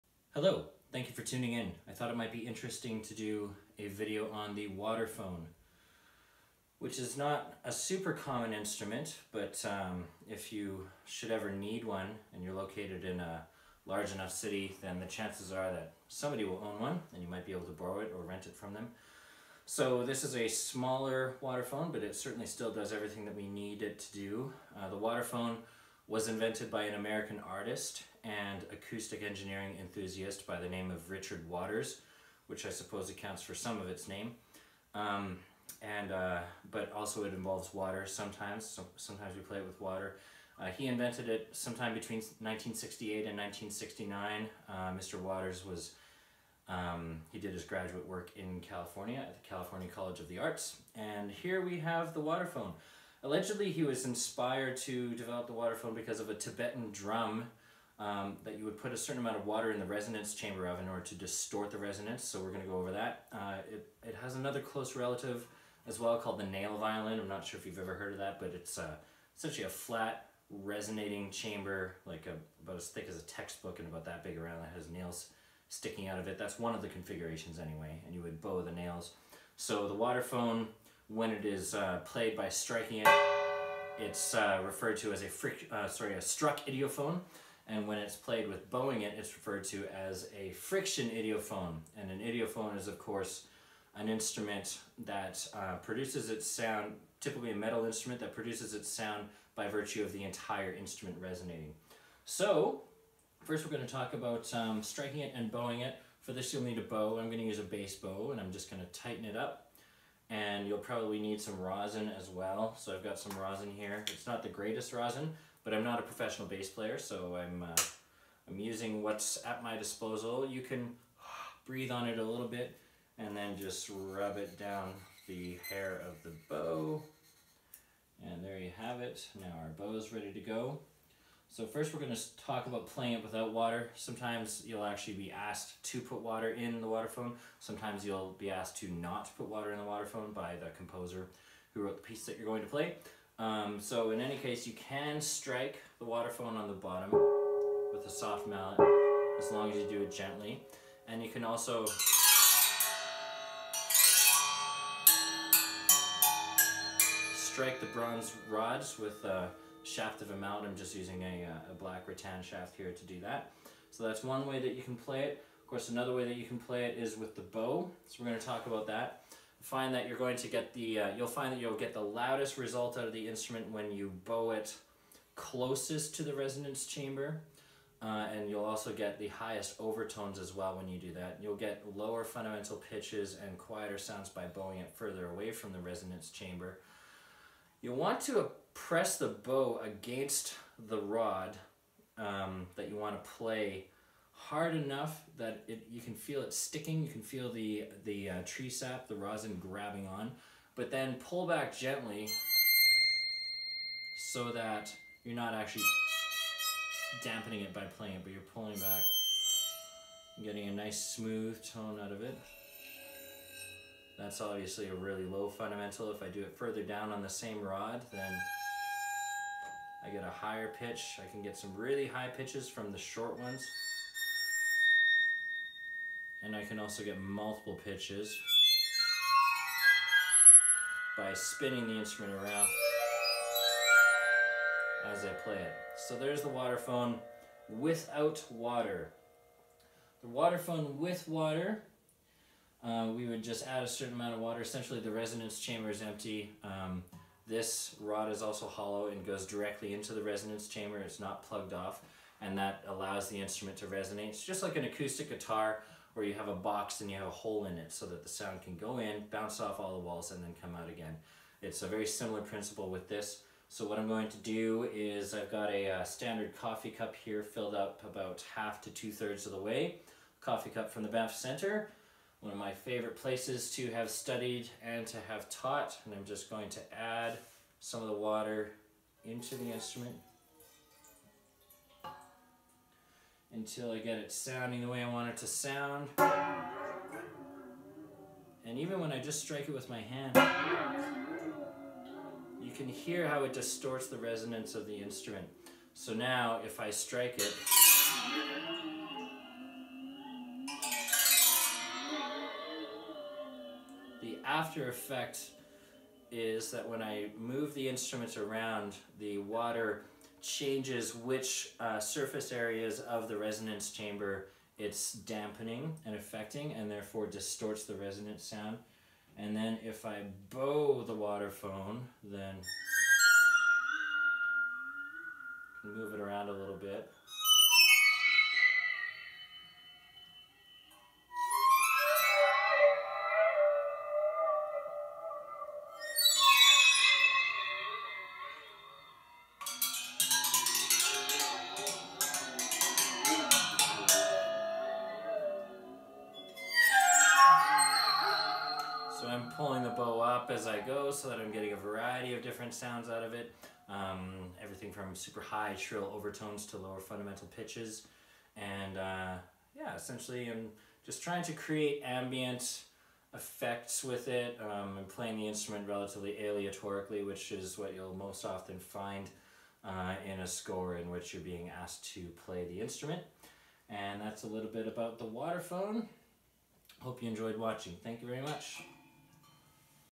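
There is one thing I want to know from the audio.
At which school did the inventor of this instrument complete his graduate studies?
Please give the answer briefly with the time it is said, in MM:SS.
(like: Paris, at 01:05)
California College of the Arts, at 00:49.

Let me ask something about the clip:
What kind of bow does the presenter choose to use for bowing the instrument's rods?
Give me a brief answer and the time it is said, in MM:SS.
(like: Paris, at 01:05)
bass bow, at 01:47.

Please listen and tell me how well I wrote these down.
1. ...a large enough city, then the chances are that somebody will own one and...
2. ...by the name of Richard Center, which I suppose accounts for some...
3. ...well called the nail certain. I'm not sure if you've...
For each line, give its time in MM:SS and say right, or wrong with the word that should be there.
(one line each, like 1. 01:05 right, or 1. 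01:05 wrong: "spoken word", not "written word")
1. 00:13 right
2. 00:30 wrong: "Waters", not "Center"
3. 01:05 wrong: "violin", not "certain".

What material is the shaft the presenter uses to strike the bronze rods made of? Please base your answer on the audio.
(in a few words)
rattan.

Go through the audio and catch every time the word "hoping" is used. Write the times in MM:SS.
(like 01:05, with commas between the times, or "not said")
not said.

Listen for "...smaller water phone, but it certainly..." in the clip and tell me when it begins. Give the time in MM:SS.
00:20.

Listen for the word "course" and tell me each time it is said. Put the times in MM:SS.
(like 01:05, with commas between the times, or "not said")
01:32, 02:45.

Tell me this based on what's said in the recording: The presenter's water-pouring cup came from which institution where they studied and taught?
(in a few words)
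Banff Center.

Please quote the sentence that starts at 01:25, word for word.
uh, sorry a struck idiophone and when it's played with bowing it, it's referred to as a friction idiophone.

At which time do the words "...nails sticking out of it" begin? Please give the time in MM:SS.
01:14.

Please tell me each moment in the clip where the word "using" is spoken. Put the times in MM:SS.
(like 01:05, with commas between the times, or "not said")
01:58, 02:40.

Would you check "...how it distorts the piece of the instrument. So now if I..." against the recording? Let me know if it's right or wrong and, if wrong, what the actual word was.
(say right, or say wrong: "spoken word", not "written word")
wrong: "resonance", not "piece".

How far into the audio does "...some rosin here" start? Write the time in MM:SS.
01:53.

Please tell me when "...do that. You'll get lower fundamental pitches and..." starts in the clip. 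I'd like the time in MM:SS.
03:00.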